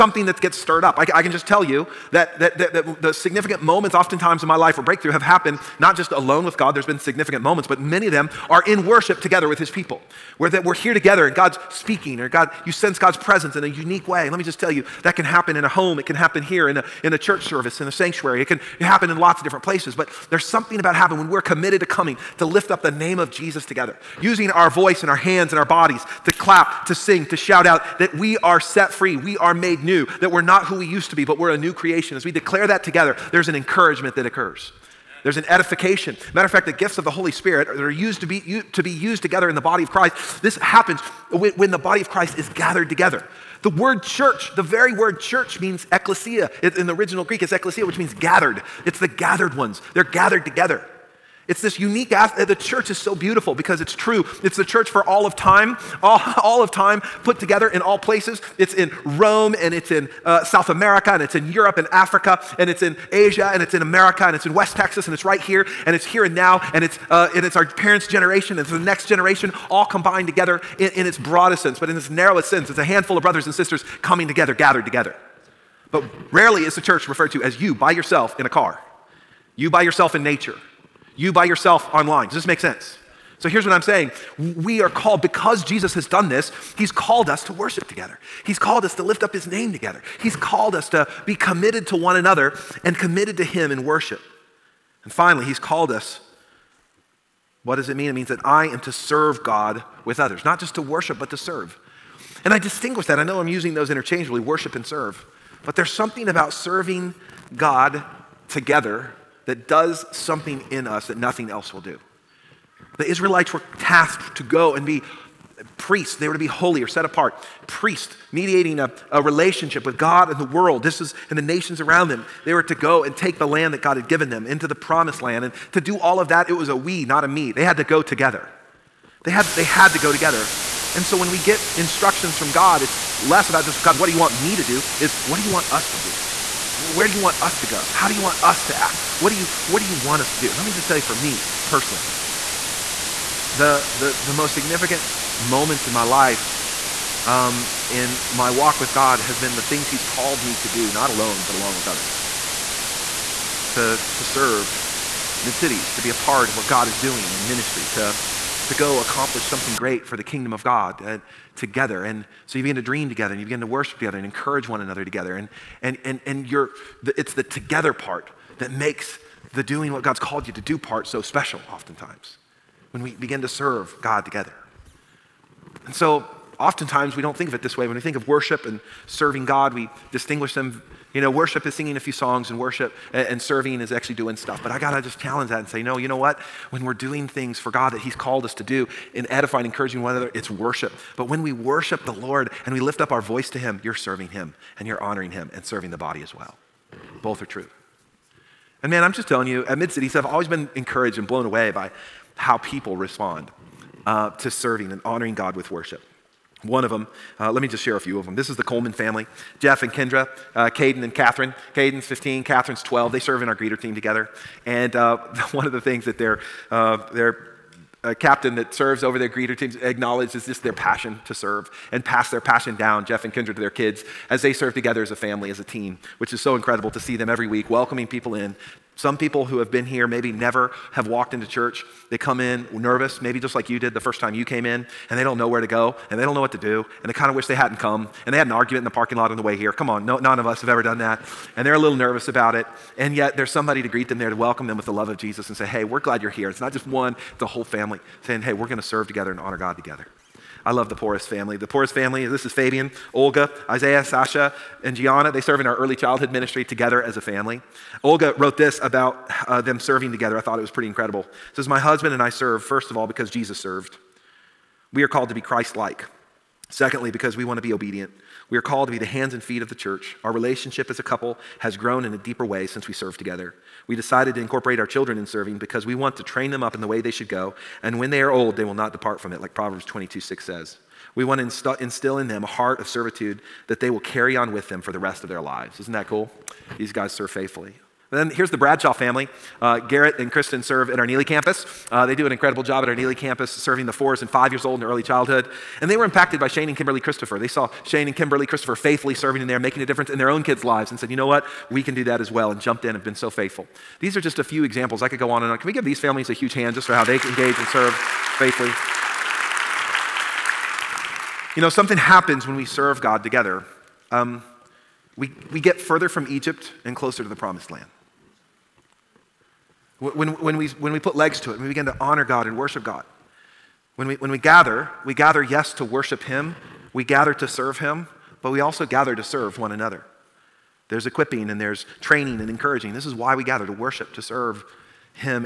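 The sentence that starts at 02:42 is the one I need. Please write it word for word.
And so you begin to dream together and you begin to worship together and encourage one another together.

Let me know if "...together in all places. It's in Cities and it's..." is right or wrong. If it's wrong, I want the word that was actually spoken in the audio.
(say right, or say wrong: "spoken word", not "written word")
wrong: "Rome", not "Cities".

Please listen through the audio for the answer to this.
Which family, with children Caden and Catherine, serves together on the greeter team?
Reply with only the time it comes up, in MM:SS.
03:28.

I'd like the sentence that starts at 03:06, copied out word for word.
When we're doing things for God that He's called us to do in edifying, encouraging one another, it's worship.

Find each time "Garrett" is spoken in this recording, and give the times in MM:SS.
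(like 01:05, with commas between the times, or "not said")
04:49.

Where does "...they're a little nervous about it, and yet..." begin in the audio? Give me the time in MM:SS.
04:01.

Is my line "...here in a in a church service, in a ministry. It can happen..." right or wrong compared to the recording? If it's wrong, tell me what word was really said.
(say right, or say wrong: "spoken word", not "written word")
wrong: "sanctuary", not "ministry".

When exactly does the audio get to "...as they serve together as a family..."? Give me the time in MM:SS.
03:44.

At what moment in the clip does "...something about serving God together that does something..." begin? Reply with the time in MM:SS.
01:45.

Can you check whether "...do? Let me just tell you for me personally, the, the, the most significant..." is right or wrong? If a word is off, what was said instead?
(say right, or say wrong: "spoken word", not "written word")
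right.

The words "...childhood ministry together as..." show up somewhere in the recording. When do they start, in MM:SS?
04:15.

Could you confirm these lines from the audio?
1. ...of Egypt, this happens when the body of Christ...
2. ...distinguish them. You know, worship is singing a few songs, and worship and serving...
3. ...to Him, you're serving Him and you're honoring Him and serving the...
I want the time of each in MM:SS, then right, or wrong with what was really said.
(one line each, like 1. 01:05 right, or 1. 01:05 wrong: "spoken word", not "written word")
1. 00:39 wrong: "Christ", not "Egypt"
2. 03:00 right
3. 03:13 right.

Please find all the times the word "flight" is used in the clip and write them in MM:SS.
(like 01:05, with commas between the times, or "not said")
not said.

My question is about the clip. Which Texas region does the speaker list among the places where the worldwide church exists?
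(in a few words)
West Texas.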